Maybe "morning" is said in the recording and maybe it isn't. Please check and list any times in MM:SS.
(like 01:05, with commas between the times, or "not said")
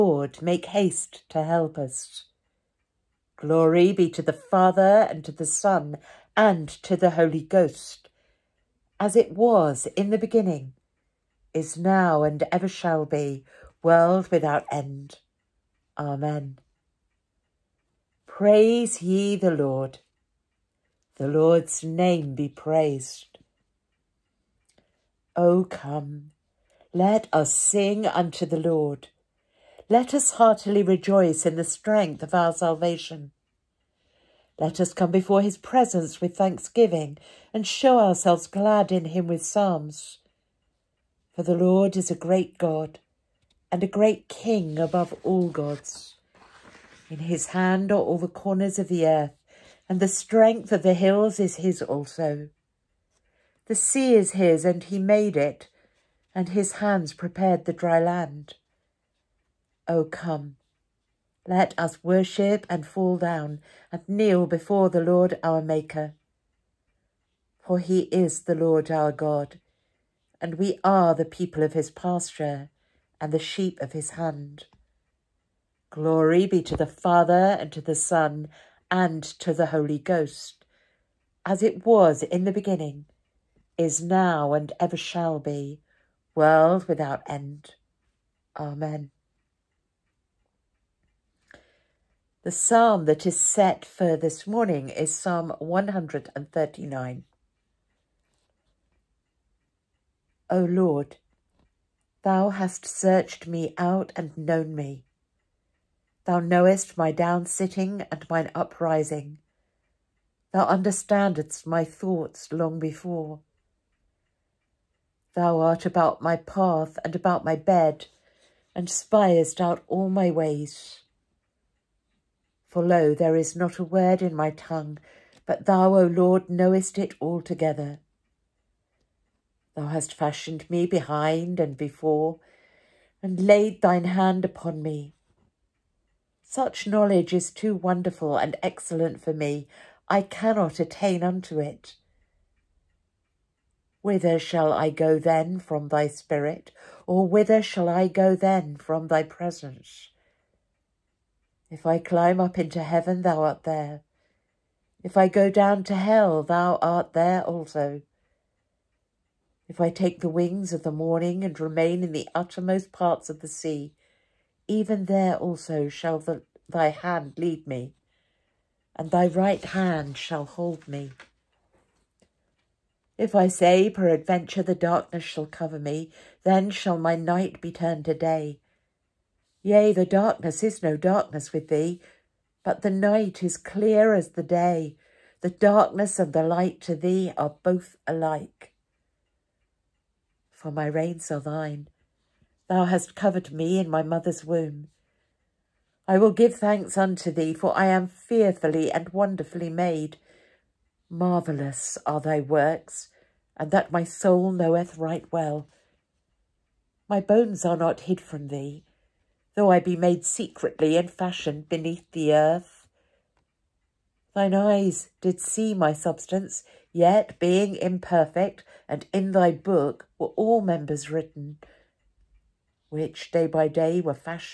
01:34, 02:40.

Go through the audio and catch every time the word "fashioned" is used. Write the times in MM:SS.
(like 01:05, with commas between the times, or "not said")
02:10, 03:31.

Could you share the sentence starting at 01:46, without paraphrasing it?
Thou knowest my down sitting and mine uprising.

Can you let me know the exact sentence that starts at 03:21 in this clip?
Marvellous are thy works, and that my soul knoweth right well.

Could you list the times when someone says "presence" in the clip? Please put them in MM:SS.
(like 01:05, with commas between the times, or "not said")
00:35, 02:29.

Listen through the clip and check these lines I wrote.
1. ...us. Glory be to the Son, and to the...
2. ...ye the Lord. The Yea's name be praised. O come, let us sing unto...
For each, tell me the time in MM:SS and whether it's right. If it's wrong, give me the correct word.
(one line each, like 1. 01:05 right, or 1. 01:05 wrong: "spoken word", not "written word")
1. 00:01 wrong: "Father", not "Son"
2. 00:18 wrong: "Lord", not "Yea".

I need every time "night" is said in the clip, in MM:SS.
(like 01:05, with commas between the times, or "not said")
02:57, 03:02.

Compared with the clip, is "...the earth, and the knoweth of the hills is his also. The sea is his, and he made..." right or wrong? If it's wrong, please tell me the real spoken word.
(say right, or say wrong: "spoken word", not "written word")
wrong: "strength", not "knoweth".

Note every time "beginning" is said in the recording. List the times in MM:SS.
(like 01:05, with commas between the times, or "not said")
00:10, 01:22.